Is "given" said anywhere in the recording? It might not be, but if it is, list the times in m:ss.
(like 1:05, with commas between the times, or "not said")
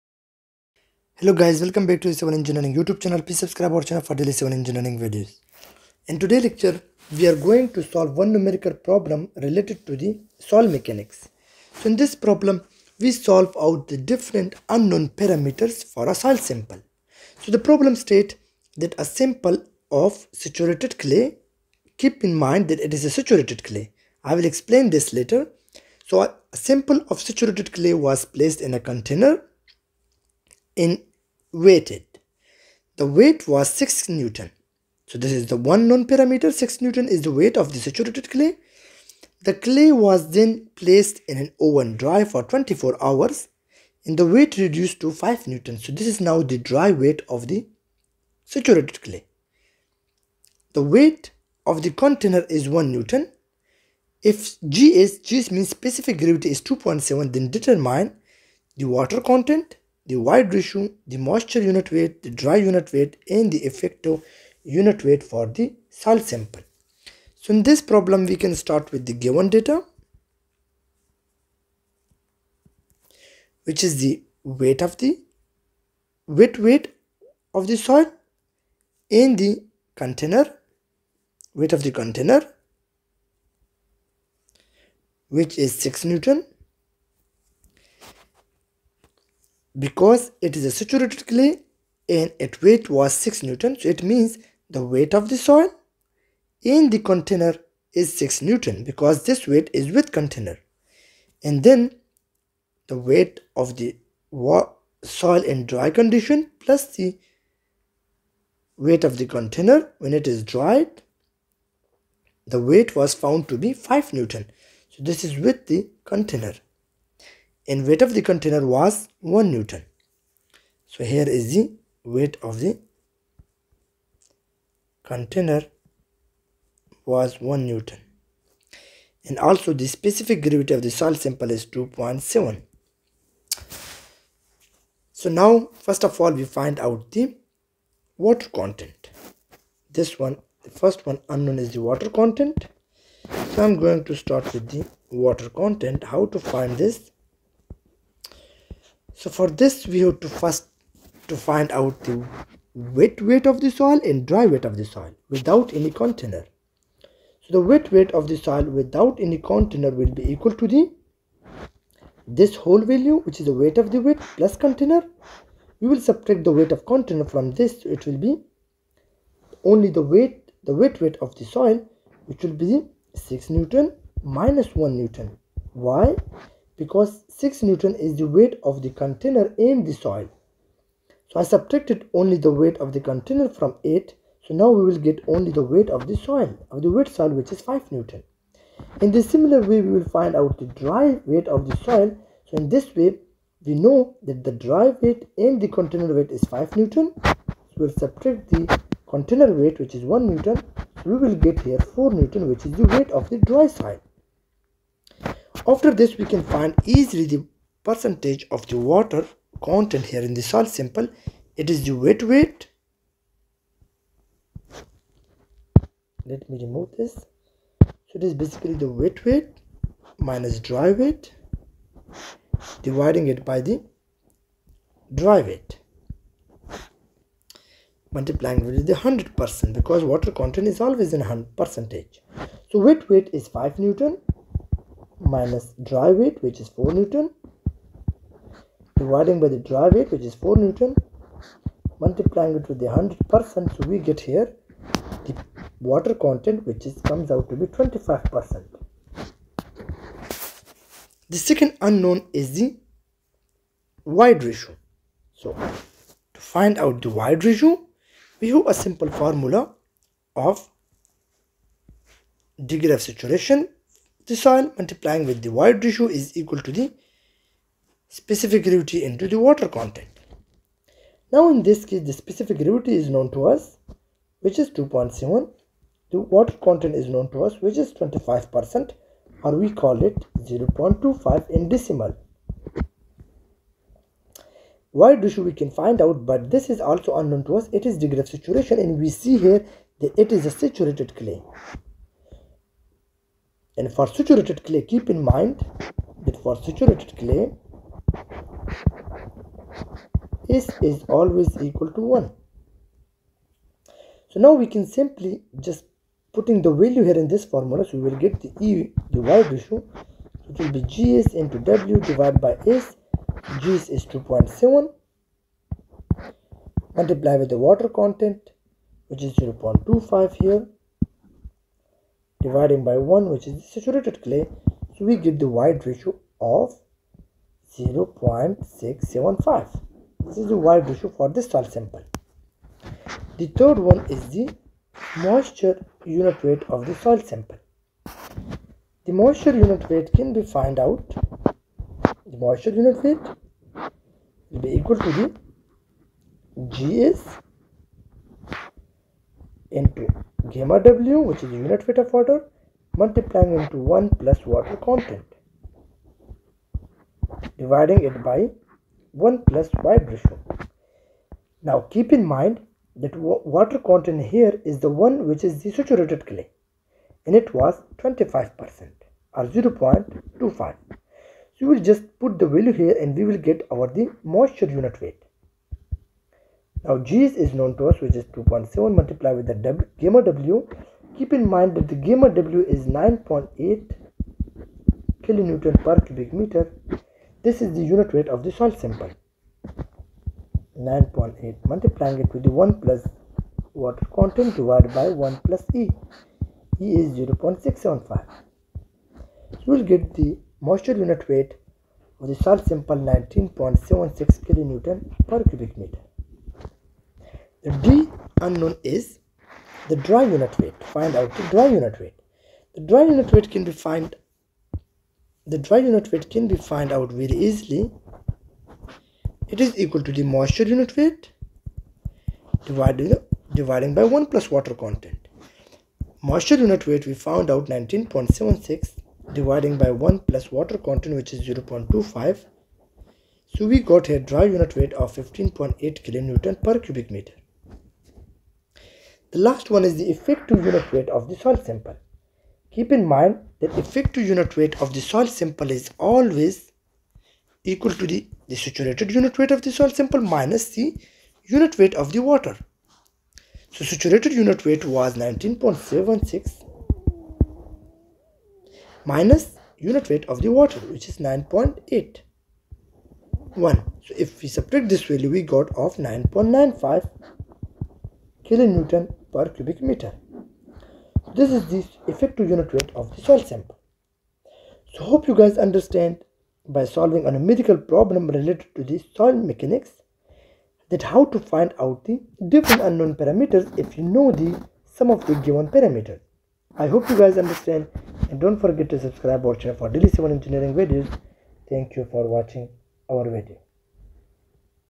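1:09, 8:05.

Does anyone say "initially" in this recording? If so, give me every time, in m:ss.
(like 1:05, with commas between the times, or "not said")
not said.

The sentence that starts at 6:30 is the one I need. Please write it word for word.
9.8 multiplying it with the 1 plus water content divided by 1 plus E.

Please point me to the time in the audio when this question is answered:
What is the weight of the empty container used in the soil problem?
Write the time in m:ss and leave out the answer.
0:50.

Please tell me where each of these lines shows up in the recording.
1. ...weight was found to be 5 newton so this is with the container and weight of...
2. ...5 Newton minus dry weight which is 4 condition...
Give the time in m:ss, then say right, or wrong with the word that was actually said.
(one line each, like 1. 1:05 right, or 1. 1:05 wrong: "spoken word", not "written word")
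1. 1:52 right
2. 3:53 wrong: "newton", not "condition".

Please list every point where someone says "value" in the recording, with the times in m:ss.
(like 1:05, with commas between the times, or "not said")
2:42, 5:06, 6:12, 7:45.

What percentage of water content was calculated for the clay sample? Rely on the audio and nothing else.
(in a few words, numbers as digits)
25%.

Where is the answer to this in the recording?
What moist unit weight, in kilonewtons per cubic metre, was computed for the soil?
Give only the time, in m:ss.
6:42.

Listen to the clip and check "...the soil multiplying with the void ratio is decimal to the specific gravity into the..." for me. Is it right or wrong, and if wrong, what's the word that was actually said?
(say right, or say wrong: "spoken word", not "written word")
wrong: "equal", not "decimal".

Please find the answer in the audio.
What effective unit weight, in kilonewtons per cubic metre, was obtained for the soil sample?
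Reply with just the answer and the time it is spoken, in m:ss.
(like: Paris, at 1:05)
9.95, at 7:45.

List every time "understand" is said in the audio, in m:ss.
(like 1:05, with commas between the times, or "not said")
7:55, 8:07.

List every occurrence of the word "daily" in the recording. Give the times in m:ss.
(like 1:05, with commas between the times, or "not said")
0:04, 8:09.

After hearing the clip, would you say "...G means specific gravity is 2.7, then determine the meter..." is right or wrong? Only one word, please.
wrong.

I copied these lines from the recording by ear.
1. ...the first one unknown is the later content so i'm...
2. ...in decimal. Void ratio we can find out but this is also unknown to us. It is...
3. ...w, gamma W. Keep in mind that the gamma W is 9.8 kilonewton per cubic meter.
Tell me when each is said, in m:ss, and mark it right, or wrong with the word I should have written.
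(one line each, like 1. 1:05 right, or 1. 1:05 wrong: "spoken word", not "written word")
1. 2:20 wrong: "water", not "later"
2. 4:41 right
3. 6:19 right.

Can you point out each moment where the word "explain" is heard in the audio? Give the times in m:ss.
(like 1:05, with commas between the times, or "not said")
0:24.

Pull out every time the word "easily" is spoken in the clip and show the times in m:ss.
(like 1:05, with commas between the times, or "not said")
3:26, 6:57.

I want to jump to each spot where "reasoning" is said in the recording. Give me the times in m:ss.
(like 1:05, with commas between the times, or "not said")
not said.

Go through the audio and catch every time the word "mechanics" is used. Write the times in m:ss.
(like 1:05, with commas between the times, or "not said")
0:10, 7:59.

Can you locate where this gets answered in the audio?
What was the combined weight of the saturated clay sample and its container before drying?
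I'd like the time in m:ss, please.
0:32.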